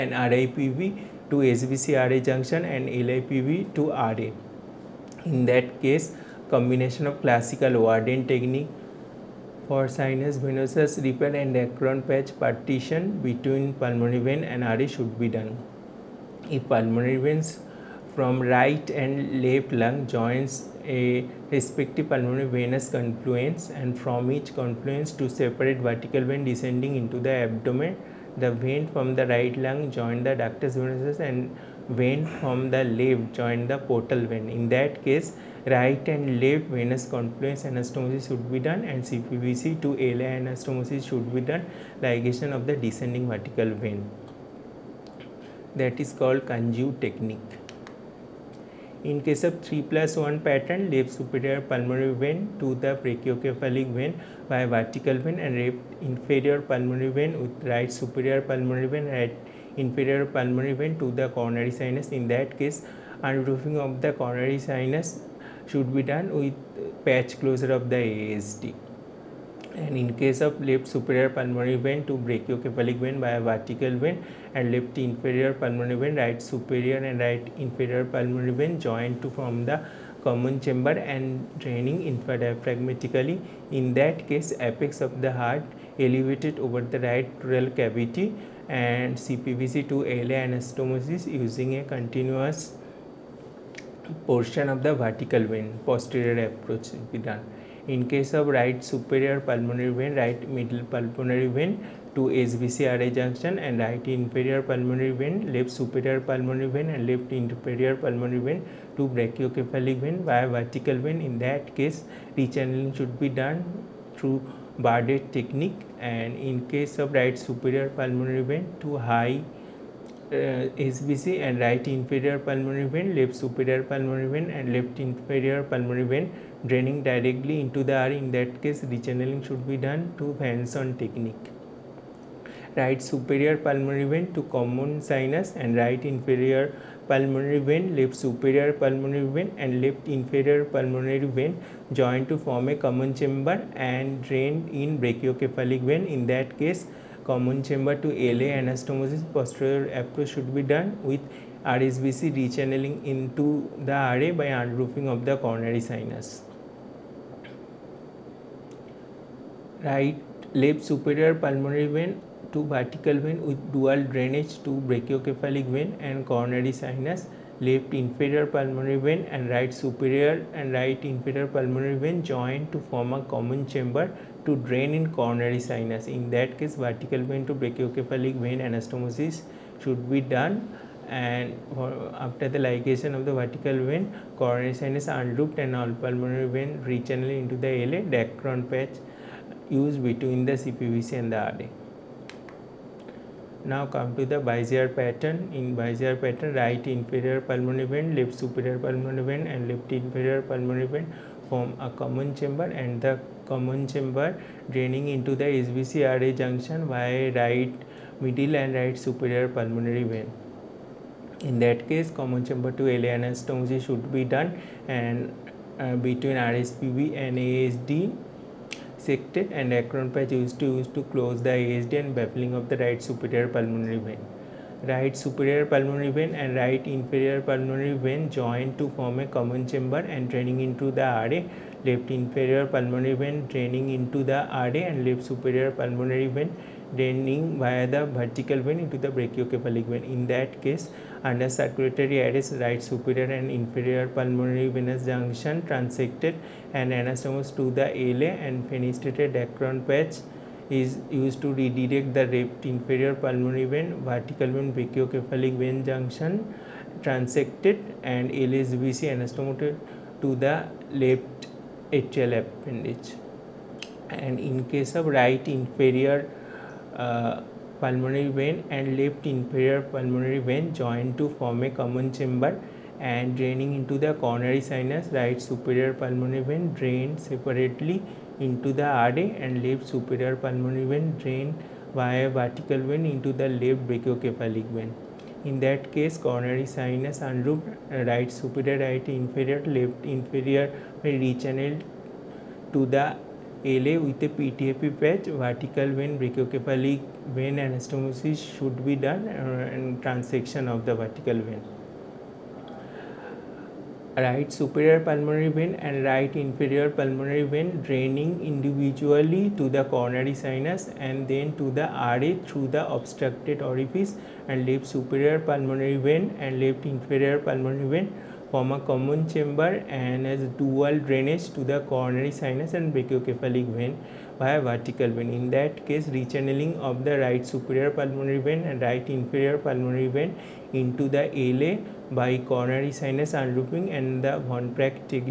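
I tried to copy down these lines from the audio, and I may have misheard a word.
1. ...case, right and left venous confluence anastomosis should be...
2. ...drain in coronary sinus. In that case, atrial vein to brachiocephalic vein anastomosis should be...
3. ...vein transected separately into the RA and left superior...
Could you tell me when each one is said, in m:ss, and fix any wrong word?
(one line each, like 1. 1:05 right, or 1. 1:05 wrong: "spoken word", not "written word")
1. 0:35 right
2. 2:54 wrong: "vertical", not "atrial"
3. 4:36 wrong: "drained", not "transected".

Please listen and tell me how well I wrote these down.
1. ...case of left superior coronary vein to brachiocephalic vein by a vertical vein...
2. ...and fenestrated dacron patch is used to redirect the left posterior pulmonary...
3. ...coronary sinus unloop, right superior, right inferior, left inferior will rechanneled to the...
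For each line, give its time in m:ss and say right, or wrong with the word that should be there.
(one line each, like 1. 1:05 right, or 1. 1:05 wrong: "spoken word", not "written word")
1. 1:10 wrong: "pulmonary", not "coronary"
2. 4:08 wrong: "inferior", not "posterior"
3. 4:46 right.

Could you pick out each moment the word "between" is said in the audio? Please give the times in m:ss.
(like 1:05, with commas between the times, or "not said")
0:13, 3:10, 3:36.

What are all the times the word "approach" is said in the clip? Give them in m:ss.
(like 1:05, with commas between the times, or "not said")
1:36, 2:30.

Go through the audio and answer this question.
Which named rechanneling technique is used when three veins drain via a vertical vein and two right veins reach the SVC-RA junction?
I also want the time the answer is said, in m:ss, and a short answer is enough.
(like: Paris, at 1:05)
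Bardet technique, at 1:54.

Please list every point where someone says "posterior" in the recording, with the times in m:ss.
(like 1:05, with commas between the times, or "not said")
1:35, 2:29.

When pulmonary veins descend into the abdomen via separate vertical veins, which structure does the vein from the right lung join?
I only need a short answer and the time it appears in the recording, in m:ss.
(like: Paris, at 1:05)
ductus venosus, at 0:30.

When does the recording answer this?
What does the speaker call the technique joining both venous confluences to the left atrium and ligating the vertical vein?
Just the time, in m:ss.
0:46.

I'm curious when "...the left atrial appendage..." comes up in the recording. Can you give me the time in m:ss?
4:20.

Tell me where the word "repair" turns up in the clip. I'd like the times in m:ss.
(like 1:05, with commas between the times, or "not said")
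0:11.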